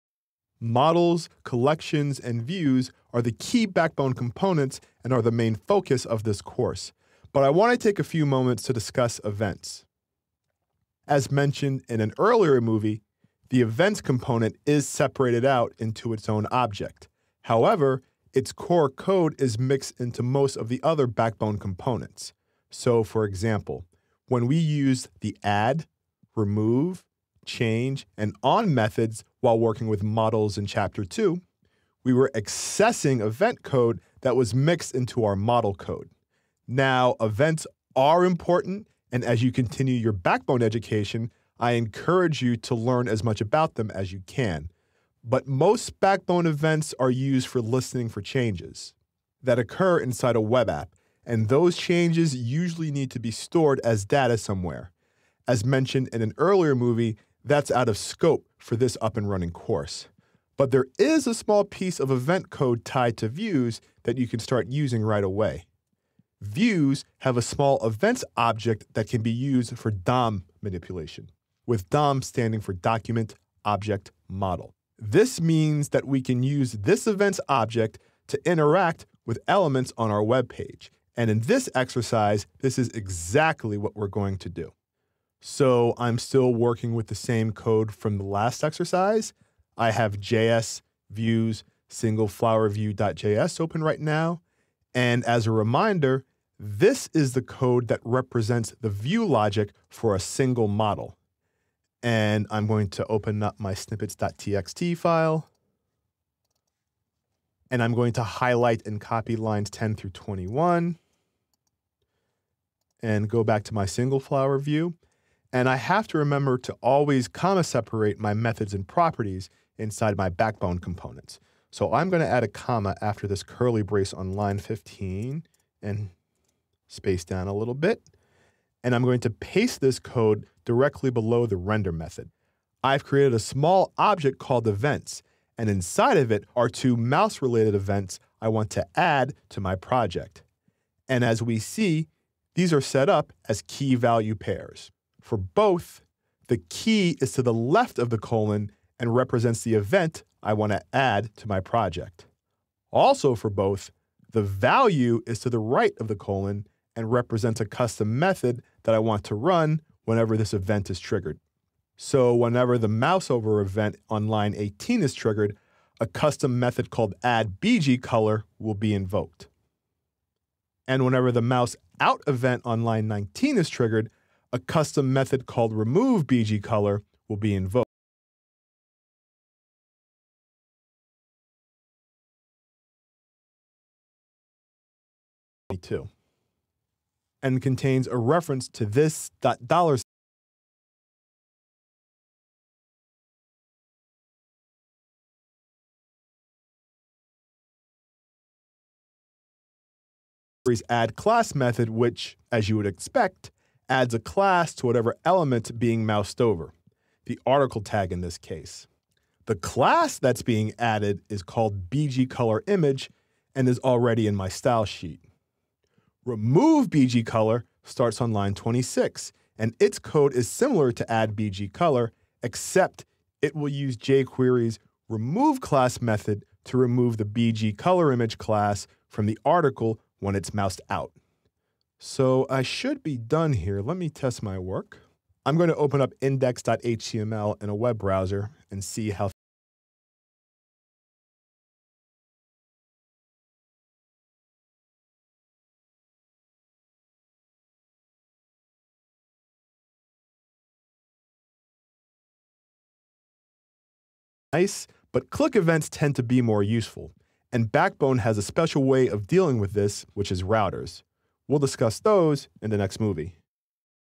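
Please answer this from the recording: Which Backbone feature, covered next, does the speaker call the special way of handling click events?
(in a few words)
routers.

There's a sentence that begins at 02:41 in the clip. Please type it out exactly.
So whenever the mouse over event on line 18 is triggered, a custom method called addBGColor will be invoked.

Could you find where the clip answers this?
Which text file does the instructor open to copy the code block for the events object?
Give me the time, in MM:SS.
01:43.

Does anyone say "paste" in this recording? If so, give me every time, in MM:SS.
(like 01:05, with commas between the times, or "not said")
02:09.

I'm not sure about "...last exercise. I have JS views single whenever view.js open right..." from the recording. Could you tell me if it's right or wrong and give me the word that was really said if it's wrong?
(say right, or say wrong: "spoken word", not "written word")
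wrong: "flower", not "whenever".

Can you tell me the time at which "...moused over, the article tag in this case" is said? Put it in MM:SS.
03:26.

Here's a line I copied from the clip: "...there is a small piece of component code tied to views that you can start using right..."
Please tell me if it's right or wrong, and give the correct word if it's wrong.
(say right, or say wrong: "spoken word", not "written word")
wrong: "event", not "component".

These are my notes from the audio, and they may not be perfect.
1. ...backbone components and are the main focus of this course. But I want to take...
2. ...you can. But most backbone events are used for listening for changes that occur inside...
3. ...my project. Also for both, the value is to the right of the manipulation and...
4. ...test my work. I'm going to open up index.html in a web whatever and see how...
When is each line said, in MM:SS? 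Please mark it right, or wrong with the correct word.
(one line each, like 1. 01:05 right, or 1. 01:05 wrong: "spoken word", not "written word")
1. 00:03 right
2. 00:44 right
3. 02:31 wrong: "colon", not "manipulation"
4. 03:54 wrong: "browser", not "whatever".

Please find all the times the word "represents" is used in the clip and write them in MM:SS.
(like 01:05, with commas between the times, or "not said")
01:38, 02:29, 02:37.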